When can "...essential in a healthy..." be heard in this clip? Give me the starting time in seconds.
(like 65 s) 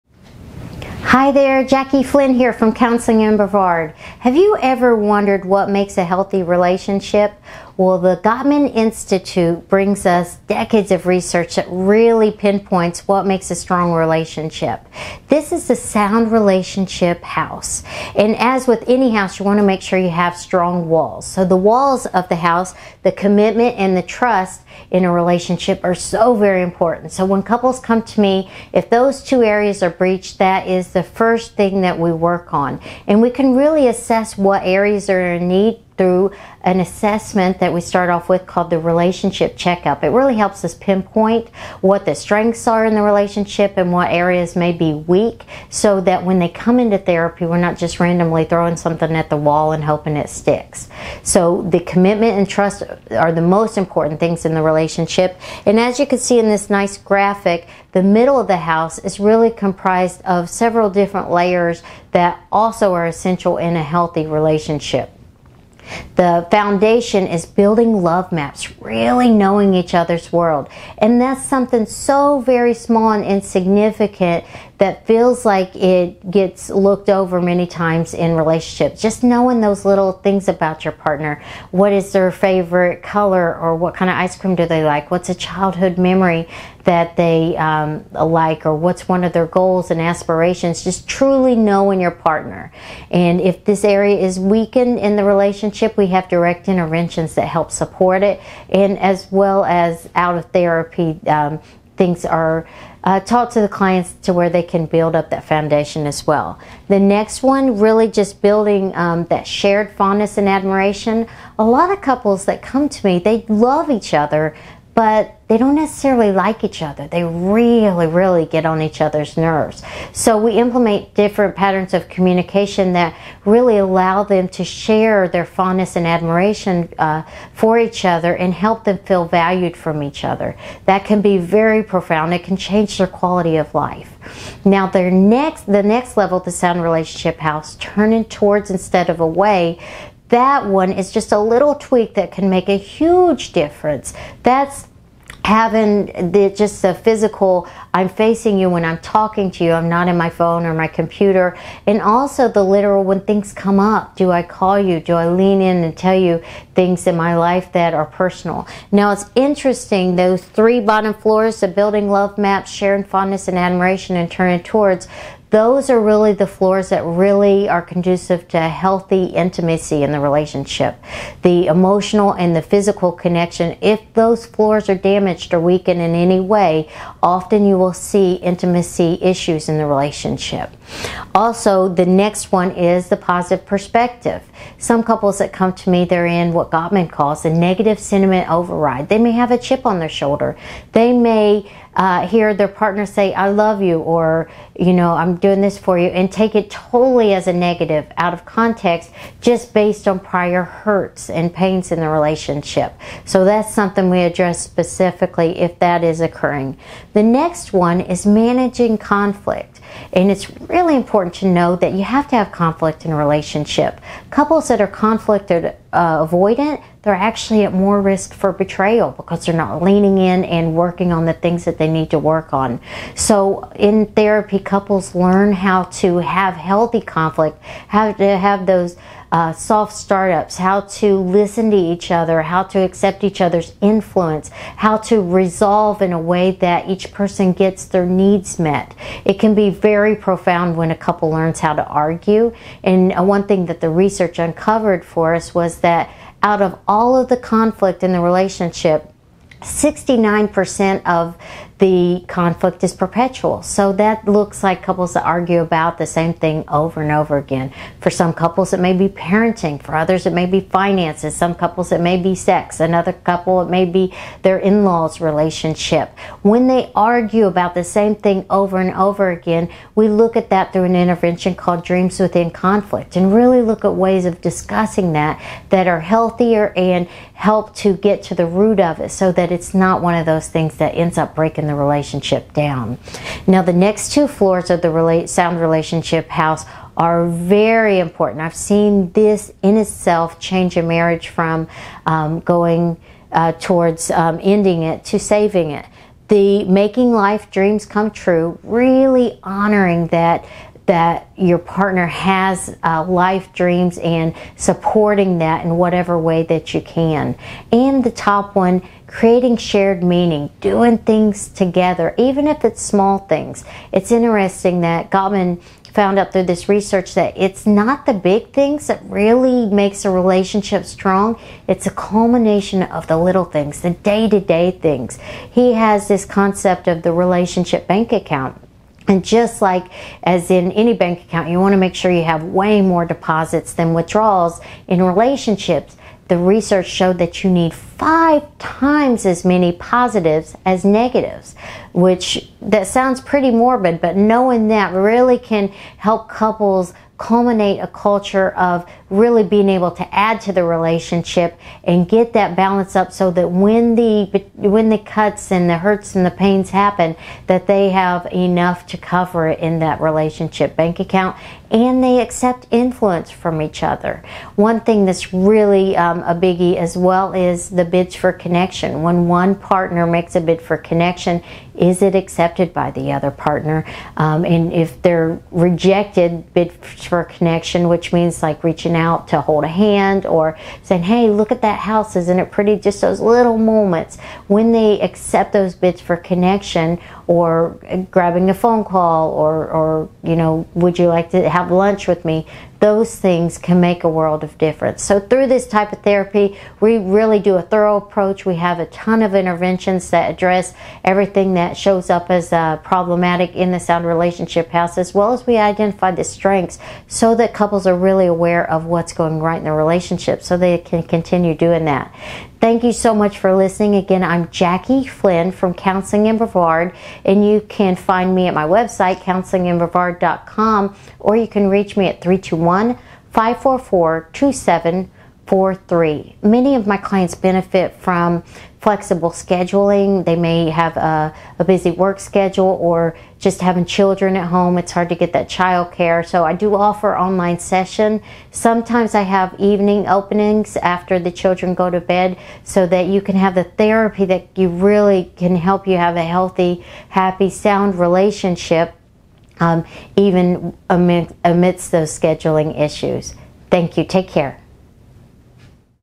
63 s.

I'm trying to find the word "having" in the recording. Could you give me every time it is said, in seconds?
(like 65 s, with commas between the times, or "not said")
145 s, 433 s.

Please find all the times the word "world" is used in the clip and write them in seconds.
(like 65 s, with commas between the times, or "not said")
70 s, 394 s.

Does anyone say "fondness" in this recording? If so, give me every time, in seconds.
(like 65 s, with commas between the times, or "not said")
109 s, 125 s, 163 s.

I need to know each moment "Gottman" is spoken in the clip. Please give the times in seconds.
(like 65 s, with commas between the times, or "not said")
8 s, 186 s, 315 s.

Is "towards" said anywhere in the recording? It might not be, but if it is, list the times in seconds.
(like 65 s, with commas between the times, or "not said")
138 s, 164 s, 293 s.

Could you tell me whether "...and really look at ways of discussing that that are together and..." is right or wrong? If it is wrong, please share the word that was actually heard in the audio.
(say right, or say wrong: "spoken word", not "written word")
wrong: "healthier", not "together".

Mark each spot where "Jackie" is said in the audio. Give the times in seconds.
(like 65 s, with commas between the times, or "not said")
1 s, 414 s.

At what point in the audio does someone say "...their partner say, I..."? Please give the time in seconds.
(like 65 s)
192 s.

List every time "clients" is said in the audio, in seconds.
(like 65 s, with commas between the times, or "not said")
103 s, 426 s.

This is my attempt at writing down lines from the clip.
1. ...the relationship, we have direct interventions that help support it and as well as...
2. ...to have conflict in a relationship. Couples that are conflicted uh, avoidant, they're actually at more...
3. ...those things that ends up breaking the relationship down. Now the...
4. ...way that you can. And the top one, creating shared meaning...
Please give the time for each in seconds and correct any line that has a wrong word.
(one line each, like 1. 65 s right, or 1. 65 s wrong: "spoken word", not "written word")
1. 95 s right
2. 212 s right
3. 280 s right
4. 306 s right.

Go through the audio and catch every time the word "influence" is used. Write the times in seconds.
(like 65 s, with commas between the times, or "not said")
233 s, 362 s.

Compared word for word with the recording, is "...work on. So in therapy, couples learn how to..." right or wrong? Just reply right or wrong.
right.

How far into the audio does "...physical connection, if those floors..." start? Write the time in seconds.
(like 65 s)
172 s.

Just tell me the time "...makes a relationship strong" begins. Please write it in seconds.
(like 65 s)
319 s.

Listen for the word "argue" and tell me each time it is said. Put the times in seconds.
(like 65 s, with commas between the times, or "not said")
241 s, 255 s, 266 s.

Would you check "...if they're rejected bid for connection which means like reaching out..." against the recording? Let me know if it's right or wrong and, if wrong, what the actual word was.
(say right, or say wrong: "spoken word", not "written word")
right.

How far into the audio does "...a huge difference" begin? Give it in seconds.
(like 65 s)
142 s.